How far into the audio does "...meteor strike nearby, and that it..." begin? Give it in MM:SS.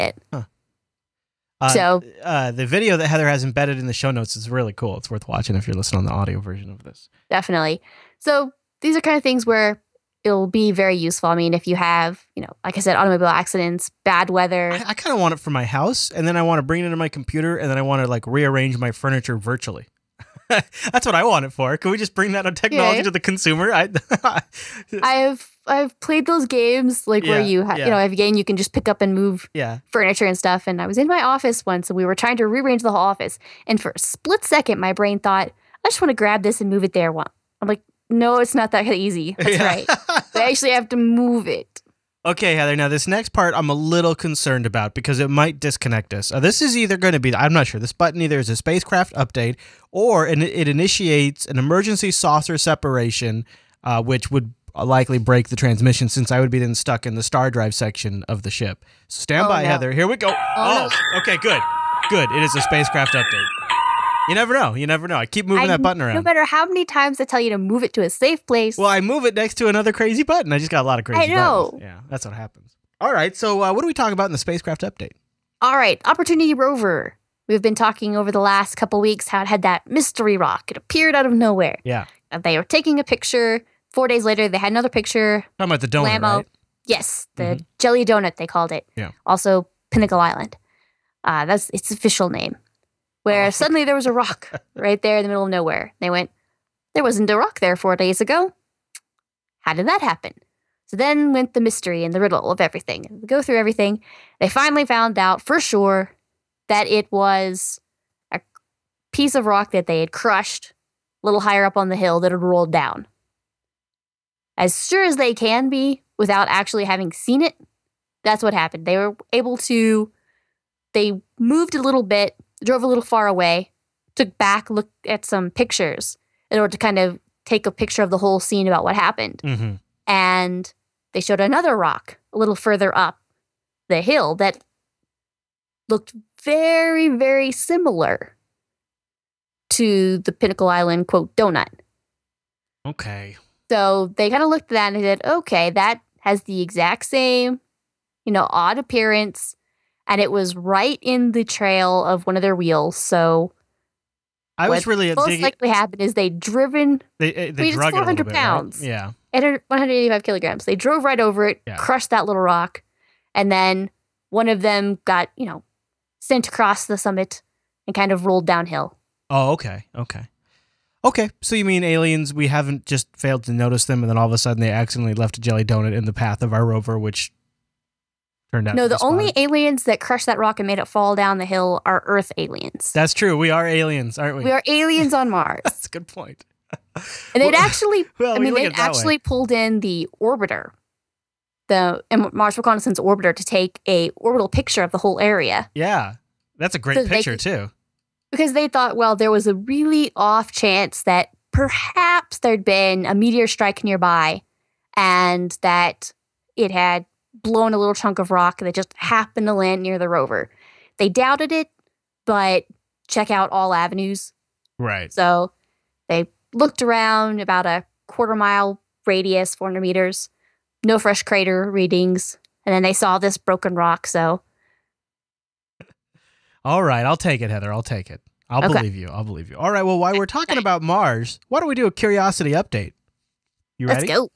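03:23.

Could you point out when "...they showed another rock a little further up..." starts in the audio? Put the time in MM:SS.
02:11.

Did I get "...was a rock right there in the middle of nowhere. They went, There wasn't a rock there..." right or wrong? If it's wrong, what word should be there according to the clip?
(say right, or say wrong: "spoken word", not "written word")
right.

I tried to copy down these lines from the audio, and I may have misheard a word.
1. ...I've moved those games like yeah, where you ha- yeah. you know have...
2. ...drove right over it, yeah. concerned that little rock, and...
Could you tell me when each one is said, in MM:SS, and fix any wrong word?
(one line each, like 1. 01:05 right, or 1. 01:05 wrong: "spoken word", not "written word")
1. 00:25 wrong: "played", not "moved"
2. 02:40 wrong: "crushed", not "concerned".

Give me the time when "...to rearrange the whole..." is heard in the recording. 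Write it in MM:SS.
00:32.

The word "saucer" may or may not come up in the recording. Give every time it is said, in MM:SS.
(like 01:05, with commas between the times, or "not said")
00:52.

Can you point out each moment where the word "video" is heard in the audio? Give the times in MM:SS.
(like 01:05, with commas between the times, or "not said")
00:02.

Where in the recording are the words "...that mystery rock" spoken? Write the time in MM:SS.
01:19.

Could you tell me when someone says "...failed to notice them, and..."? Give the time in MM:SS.
02:53.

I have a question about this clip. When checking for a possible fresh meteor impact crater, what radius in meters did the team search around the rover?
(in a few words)
400 meters.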